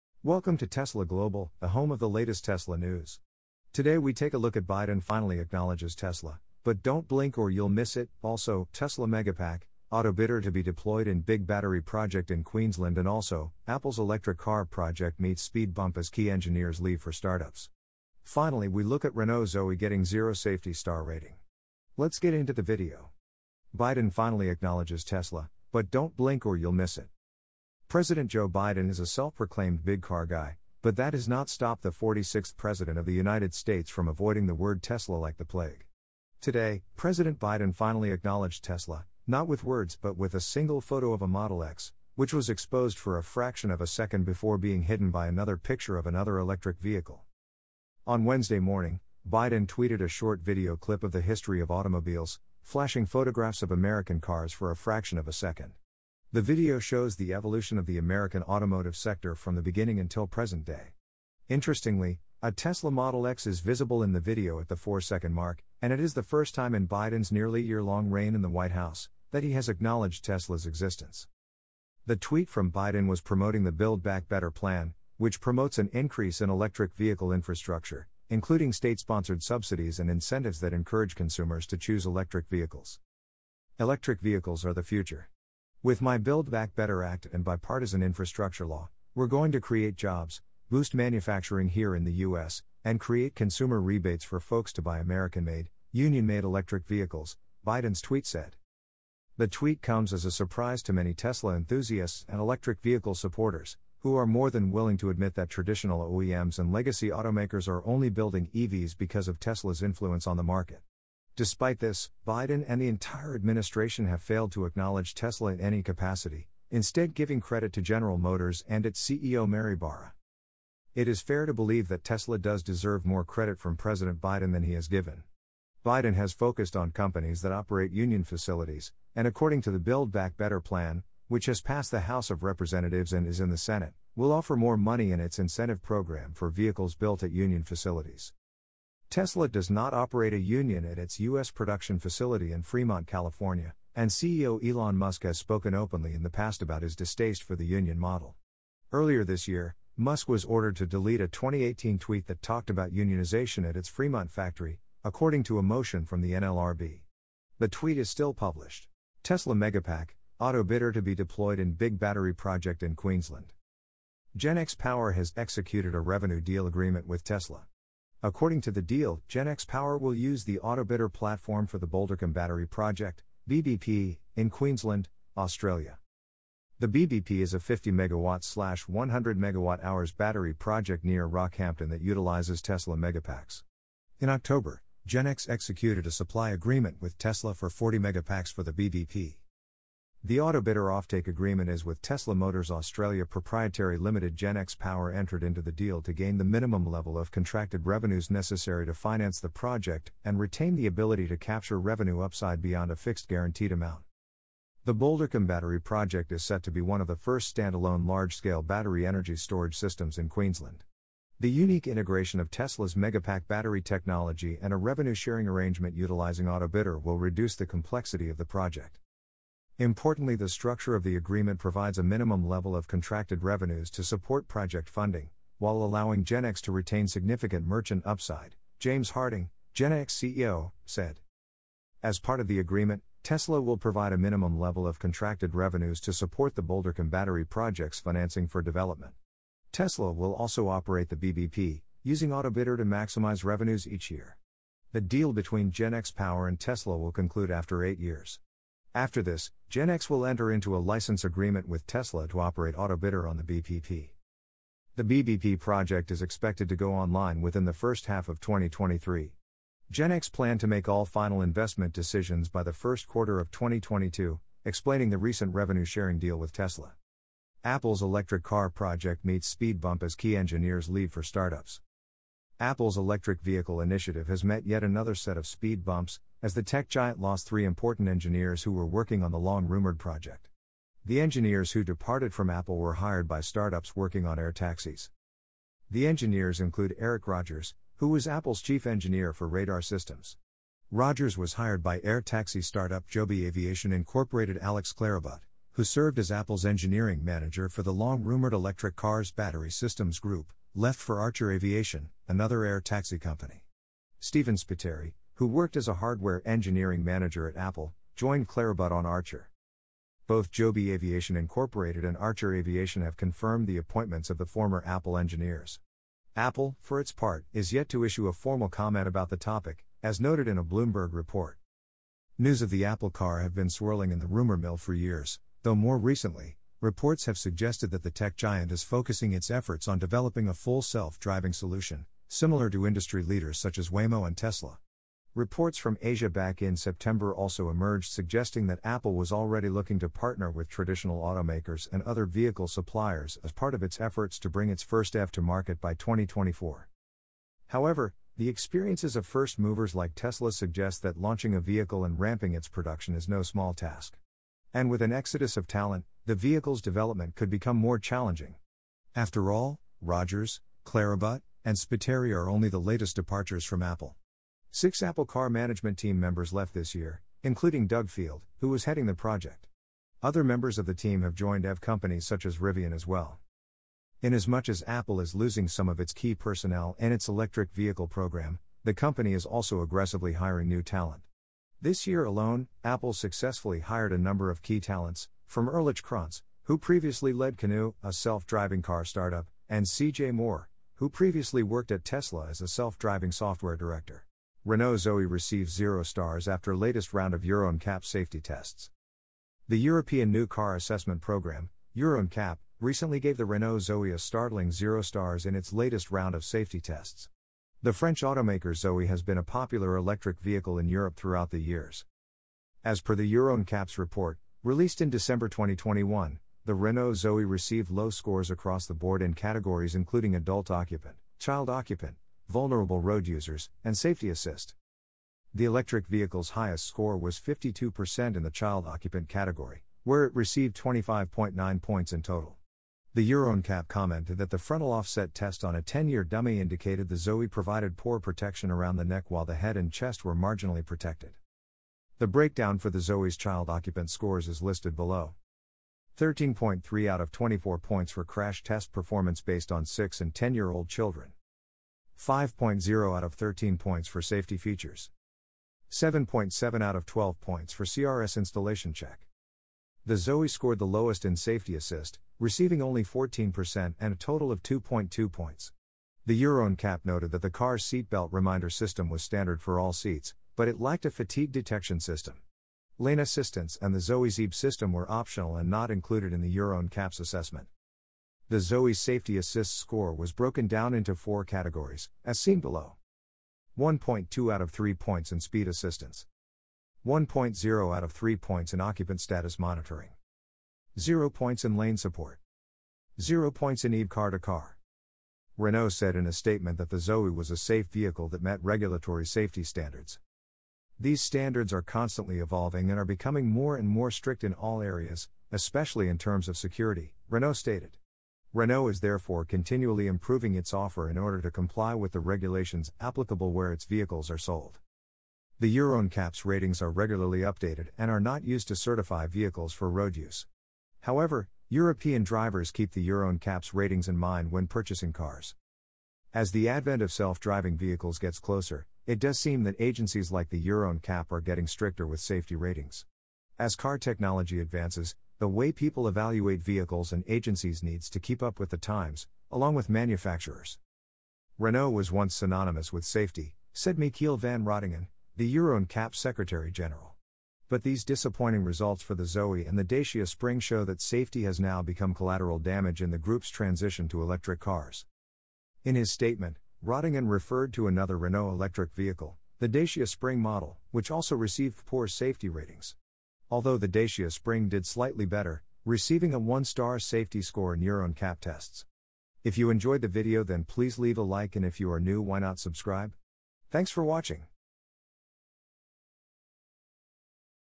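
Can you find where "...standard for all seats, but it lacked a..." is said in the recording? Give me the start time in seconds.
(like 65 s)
469 s.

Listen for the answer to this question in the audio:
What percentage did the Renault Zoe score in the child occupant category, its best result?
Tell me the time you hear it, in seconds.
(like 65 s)
427 s.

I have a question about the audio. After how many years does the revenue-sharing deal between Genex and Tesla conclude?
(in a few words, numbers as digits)
8.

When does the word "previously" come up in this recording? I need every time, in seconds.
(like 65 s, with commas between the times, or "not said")
386 s, 391 s.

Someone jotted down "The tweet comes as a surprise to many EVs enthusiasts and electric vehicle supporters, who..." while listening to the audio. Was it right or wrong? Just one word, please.
wrong.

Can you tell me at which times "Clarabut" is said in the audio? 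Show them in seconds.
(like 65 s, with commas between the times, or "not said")
294 s, 308 s, 360 s.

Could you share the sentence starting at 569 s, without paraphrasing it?
If you enjoyed the video then please leave a like and if you are new why not subscribe?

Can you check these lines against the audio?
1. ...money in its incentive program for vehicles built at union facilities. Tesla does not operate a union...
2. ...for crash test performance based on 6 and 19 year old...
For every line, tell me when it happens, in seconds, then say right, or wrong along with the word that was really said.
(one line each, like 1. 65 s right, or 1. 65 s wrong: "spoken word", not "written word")
1. 134 s right
2. 448 s wrong: "10", not "19".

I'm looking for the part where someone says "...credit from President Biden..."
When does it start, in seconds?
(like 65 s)
123 s.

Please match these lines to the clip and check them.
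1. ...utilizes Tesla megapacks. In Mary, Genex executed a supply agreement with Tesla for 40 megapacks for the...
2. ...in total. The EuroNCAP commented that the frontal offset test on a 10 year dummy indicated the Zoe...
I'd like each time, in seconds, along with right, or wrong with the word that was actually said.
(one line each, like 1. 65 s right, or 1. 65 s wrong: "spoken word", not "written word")
1. 182 s wrong: "October", not "Mary"
2. 432 s right.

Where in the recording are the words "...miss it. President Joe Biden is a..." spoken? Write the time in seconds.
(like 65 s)
26 s.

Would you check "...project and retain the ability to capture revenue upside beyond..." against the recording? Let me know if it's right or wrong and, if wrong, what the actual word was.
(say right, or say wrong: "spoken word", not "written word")
right.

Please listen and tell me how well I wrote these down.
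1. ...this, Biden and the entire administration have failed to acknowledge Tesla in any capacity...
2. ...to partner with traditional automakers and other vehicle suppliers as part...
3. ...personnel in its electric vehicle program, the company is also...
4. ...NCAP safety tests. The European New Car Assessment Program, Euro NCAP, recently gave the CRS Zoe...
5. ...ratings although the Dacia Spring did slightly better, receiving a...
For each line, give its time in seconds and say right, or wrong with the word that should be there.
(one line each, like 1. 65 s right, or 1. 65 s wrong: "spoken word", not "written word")
1. 111 s right
2. 339 s right
3. 376 s right
4. 397 s wrong: "Renault", not "CRS"
5. 562 s right.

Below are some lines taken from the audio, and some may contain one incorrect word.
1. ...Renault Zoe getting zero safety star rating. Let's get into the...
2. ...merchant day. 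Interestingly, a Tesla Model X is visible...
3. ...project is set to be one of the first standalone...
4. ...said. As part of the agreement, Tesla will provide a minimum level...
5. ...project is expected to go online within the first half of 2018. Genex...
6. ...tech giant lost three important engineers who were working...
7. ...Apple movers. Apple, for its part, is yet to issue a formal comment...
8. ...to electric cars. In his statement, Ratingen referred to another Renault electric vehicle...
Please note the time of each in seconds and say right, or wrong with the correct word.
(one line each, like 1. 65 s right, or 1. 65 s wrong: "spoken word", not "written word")
1. 19 s right
2. 60 s wrong: "present", not "merchant"
3. 205 s right
4. 230 s right
5. 255 s wrong: "2023", not "2018"
6. 276 s right
7. 314 s wrong: "engineers", not "movers"
8. 554 s right.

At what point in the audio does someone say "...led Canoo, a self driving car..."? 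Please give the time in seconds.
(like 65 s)
387 s.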